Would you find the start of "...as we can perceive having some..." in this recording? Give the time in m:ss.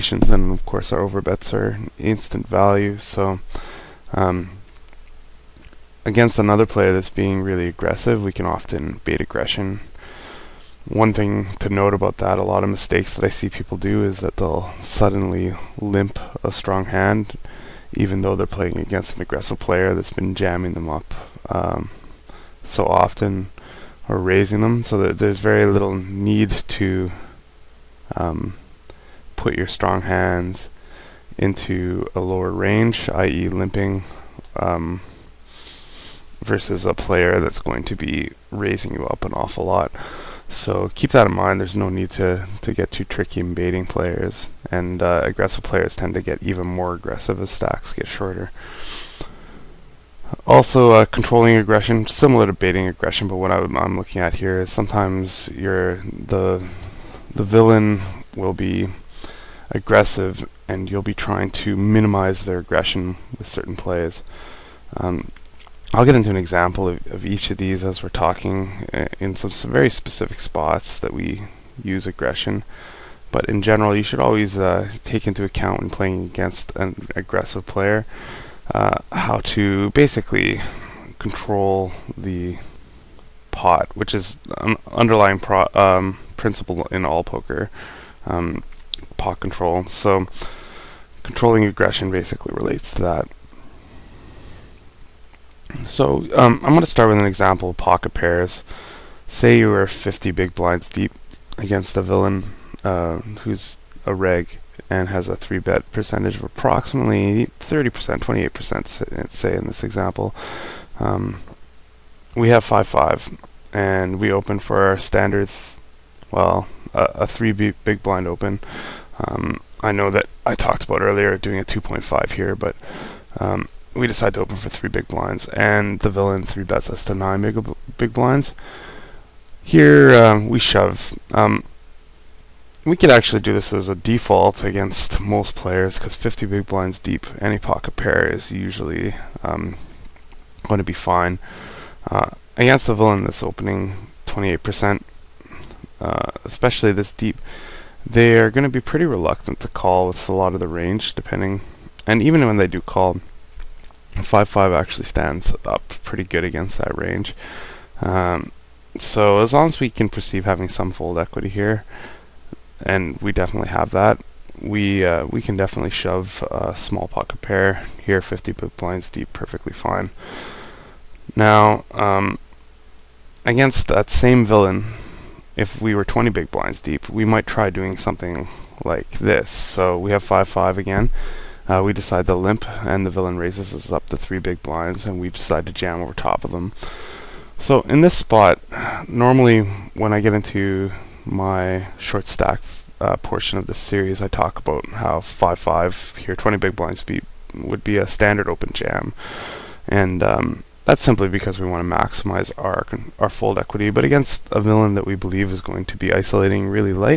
2:39.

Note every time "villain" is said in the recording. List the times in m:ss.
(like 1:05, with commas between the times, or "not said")
0:57, 1:42, 2:06, 2:22, 2:54, 3:03, 3:24.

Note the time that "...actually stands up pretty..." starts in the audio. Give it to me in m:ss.
2:34.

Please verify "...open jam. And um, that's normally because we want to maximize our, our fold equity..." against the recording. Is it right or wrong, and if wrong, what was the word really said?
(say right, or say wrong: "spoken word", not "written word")
wrong: "simply", not "normally".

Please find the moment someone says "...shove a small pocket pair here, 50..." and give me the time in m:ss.
2:45.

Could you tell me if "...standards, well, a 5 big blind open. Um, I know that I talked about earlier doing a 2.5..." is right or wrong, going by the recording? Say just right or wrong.
wrong.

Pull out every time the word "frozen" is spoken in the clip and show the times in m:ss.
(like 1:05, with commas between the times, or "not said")
not said.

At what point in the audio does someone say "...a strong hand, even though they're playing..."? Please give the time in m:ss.
0:16.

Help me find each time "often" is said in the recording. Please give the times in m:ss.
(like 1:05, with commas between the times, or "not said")
0:08, 0:22.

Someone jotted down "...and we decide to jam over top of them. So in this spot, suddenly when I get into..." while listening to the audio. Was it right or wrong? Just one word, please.
wrong.